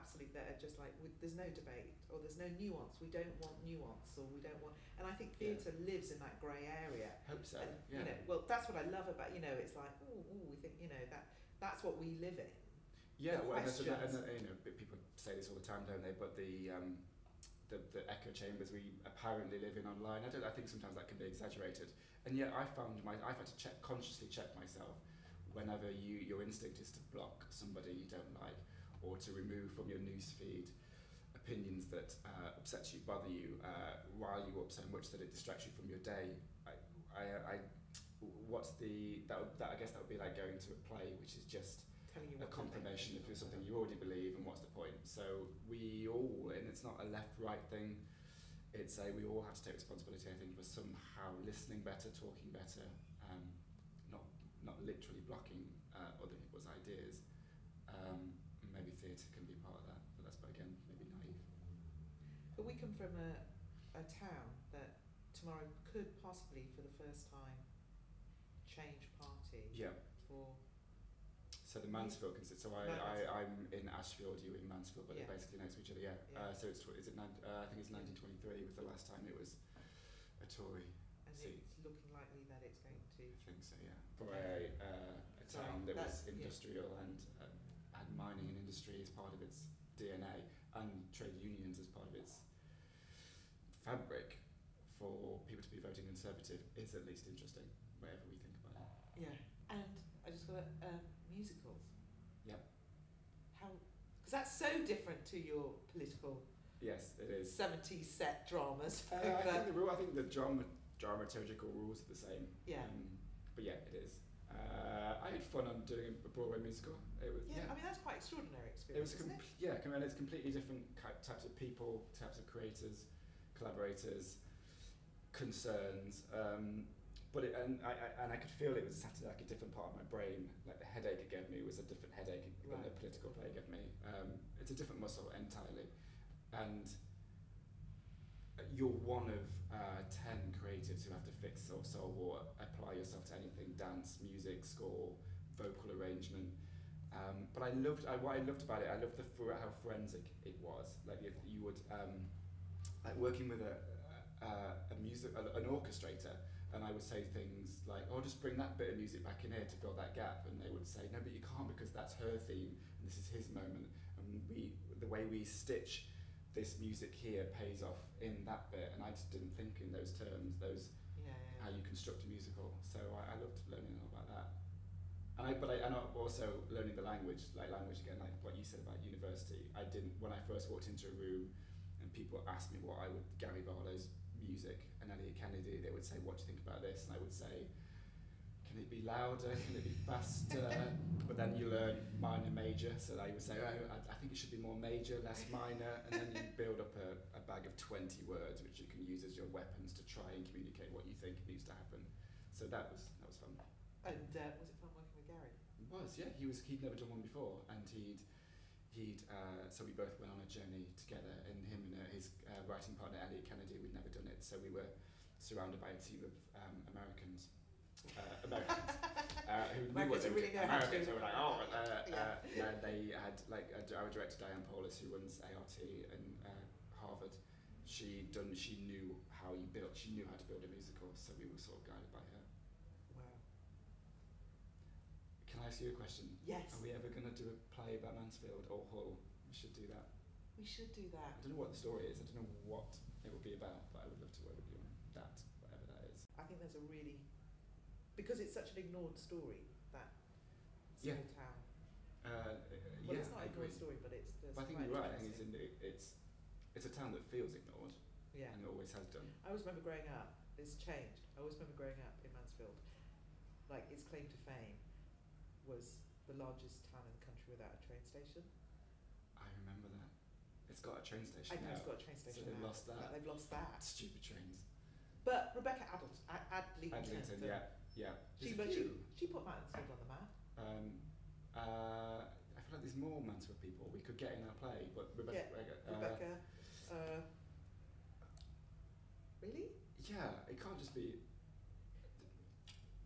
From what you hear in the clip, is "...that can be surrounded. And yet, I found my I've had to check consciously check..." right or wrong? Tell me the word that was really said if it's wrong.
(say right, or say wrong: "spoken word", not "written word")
wrong: "exaggerated", not "surrounded".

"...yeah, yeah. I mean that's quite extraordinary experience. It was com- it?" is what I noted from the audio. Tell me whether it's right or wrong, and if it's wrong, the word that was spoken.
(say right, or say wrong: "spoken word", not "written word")
right.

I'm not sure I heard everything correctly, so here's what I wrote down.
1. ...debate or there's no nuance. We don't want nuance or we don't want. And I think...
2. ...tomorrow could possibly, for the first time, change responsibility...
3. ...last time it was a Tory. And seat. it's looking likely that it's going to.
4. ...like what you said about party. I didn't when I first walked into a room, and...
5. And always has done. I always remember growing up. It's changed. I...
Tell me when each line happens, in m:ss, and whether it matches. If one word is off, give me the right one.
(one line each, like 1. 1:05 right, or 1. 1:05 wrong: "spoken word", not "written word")
1. 0:01 right
2. 1:05 wrong: "party", not "responsibility"
3. 1:18 right
4. 2:58 wrong: "university", not "party"
5. 4:18 right.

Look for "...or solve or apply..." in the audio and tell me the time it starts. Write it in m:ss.
2:21.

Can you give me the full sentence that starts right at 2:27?
Um, but I loved I, what I loved about it.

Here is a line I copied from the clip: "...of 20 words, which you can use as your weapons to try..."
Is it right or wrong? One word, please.
right.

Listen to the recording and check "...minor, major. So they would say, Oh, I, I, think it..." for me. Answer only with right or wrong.
right.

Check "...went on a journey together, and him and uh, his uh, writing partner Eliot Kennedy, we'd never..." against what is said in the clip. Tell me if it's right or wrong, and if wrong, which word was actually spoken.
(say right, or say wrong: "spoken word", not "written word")
right.